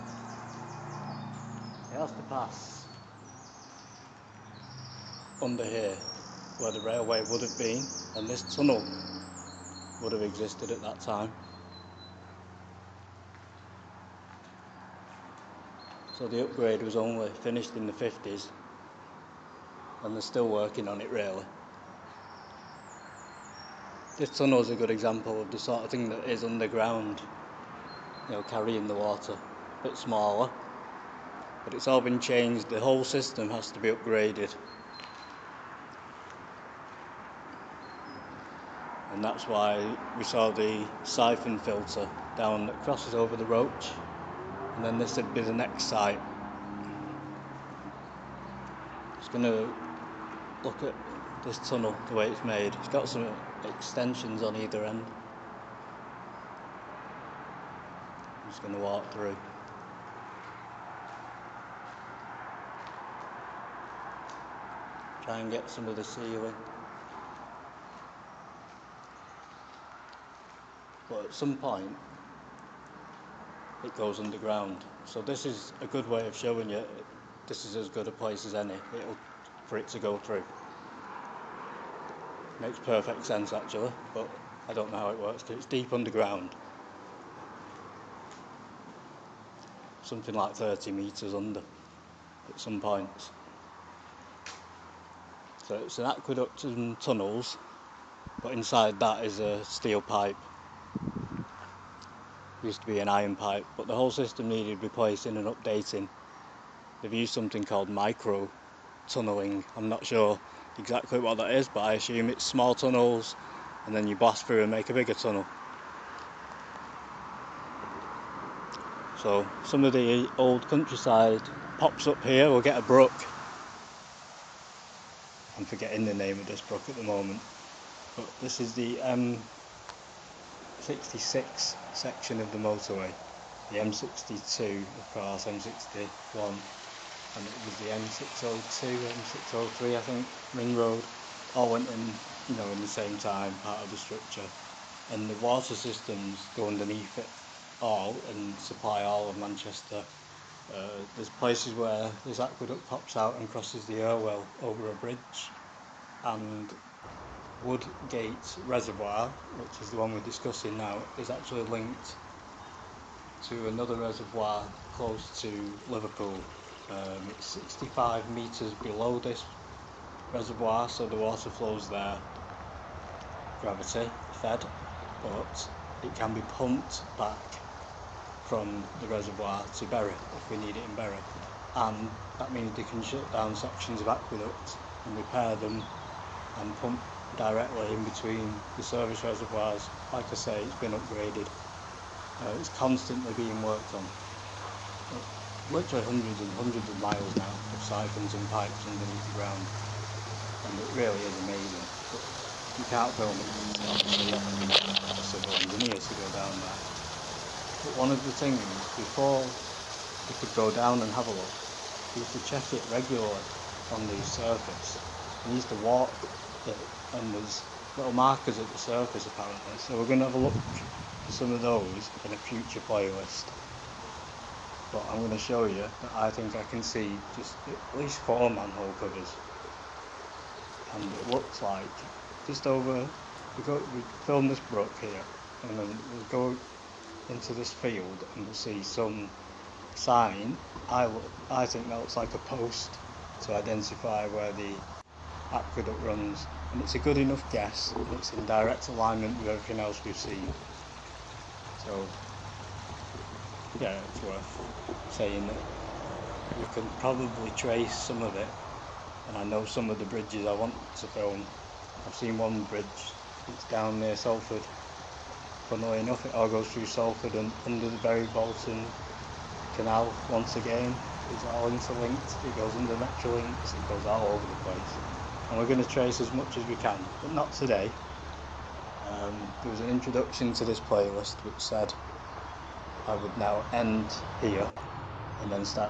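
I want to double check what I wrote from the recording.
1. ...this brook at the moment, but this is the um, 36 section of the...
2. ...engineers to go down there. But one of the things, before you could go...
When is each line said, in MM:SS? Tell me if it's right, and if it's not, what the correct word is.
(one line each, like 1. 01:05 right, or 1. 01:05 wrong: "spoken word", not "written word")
1. 02:06 wrong: "66", not "36"
2. 03:25 right.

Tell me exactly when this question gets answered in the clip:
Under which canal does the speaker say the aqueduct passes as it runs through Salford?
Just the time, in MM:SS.
04:27.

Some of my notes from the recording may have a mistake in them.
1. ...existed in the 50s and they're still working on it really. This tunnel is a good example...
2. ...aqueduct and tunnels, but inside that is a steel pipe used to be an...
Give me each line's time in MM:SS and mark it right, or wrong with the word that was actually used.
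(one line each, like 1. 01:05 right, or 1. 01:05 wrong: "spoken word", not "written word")
1. 00:17 wrong: "finished", not "existed"
2. 01:36 right.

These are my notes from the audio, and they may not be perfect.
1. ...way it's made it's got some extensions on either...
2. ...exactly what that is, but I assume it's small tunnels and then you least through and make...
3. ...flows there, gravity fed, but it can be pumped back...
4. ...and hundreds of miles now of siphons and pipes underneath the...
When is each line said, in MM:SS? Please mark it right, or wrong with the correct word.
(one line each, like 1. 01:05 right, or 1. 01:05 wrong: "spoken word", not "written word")
1. 00:52 right
2. 01:50 wrong: "blast", not "least"
3. 02:51 right
4. 03:16 right.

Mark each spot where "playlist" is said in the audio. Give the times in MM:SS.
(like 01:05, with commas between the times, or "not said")
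03:42, 04:40.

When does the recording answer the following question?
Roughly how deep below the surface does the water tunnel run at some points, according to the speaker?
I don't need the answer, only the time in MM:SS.
01:30.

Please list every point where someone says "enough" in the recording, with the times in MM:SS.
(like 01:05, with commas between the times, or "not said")
04:07, 04:25.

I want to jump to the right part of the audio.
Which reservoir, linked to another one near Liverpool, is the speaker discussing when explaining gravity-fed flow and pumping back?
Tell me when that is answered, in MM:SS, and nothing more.
02:37.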